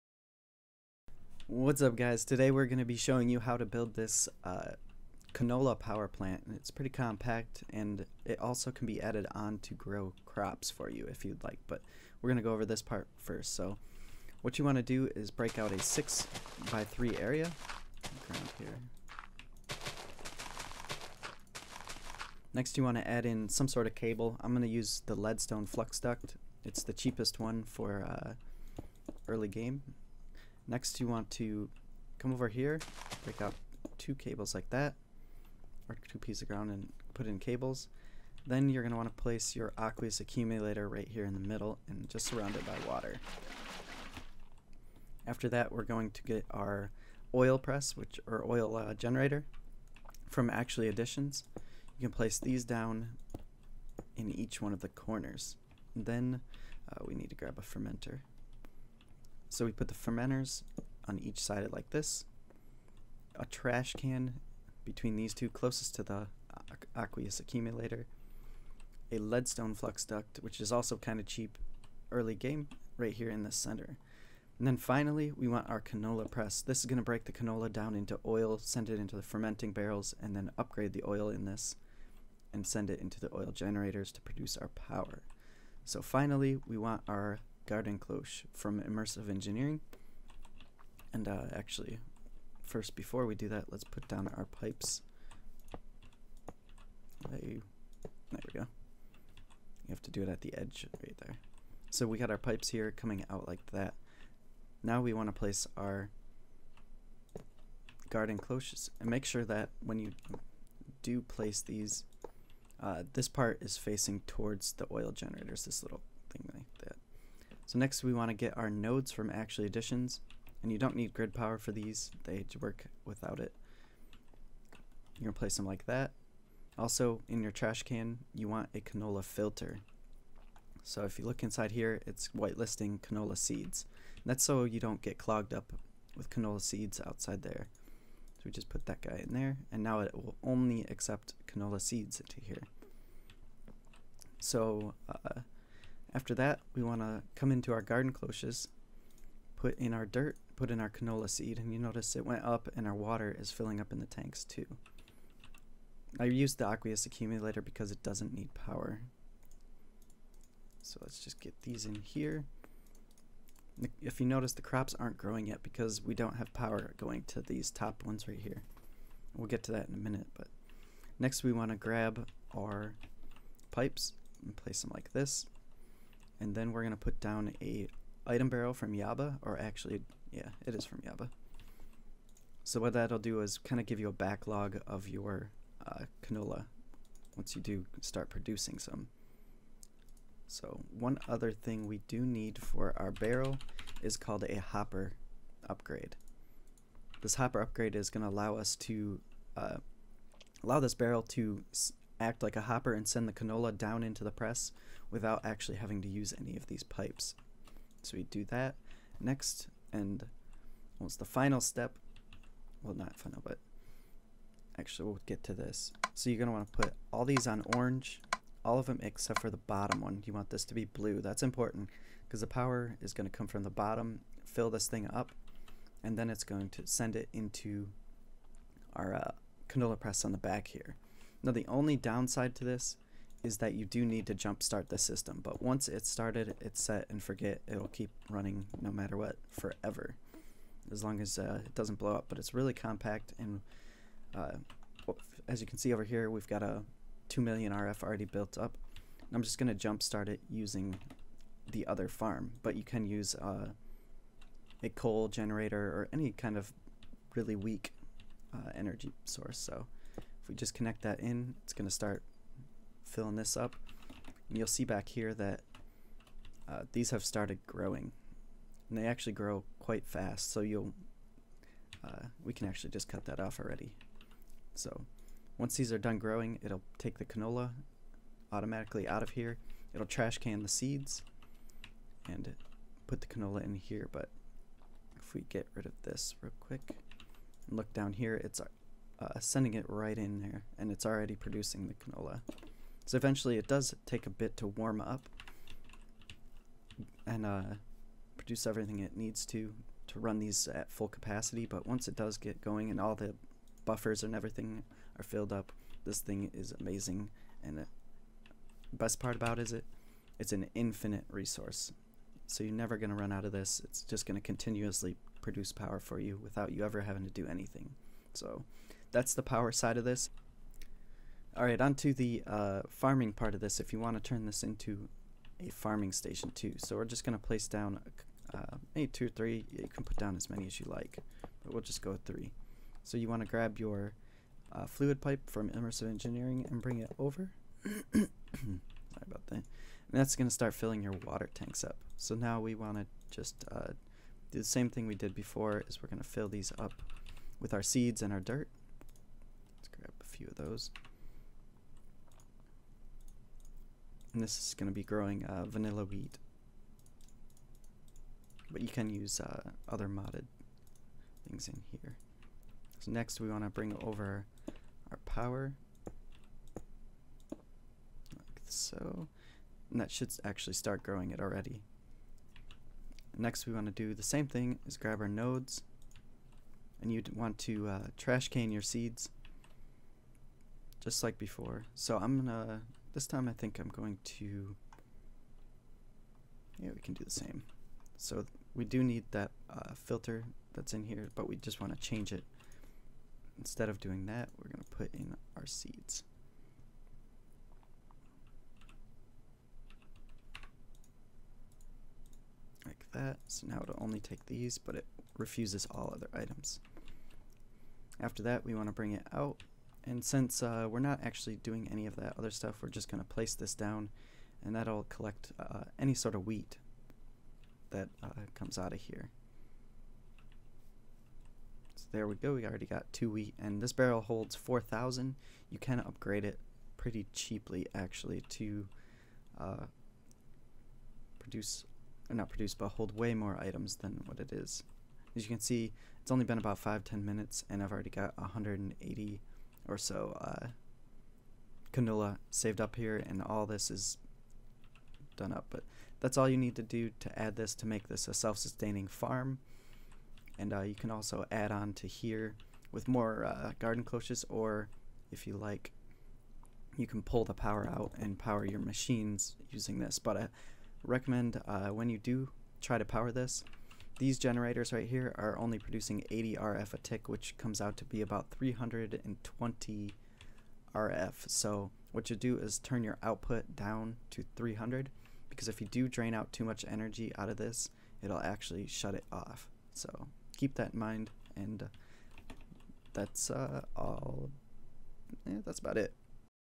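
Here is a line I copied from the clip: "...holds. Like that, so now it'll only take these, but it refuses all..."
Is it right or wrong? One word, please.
wrong.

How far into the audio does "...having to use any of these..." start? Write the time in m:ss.
3:25.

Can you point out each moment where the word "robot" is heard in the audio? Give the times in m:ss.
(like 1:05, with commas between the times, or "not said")
not said.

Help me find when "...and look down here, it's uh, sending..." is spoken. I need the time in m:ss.
4:47.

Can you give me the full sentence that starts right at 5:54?
And this is going to be growing uh, vanilla wheat.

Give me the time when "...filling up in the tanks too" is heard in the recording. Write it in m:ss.
2:33.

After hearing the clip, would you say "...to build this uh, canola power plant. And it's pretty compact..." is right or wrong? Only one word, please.
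right.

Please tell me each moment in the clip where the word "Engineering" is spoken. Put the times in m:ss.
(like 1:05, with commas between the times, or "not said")
1:29, 5:36.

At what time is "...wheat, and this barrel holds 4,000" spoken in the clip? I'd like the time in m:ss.
7:03.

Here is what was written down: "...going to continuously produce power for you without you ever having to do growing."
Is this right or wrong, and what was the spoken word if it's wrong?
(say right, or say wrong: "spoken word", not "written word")
wrong: "anything", not "growing".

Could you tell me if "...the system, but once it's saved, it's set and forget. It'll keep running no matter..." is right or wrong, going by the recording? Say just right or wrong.
wrong.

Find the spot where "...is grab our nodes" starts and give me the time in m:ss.
6:14.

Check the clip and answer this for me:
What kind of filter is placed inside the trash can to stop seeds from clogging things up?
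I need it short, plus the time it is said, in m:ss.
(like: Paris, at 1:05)
canola filter, at 2:08.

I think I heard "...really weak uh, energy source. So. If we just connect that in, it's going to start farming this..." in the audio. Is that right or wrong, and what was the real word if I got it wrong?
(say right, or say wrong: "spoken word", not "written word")
wrong: "filling", not "farming".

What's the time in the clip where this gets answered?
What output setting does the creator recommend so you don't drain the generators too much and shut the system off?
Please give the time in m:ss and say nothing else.
7:54.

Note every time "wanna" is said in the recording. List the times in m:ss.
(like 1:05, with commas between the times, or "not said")
6:31, 6:48.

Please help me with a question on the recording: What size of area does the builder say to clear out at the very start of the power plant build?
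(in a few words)
6 by 3.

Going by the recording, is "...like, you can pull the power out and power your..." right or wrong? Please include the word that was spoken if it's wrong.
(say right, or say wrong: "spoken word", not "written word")
right.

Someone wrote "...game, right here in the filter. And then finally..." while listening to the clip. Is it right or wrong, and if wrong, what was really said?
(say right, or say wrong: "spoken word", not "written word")
wrong: "center", not "filter".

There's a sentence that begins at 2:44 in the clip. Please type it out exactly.
If you notice, the crops aren't growing yet because we don't have power going to these top ones right here.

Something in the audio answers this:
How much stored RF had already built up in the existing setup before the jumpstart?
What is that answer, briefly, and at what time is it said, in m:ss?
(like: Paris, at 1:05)
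2 million RF, at 4:07.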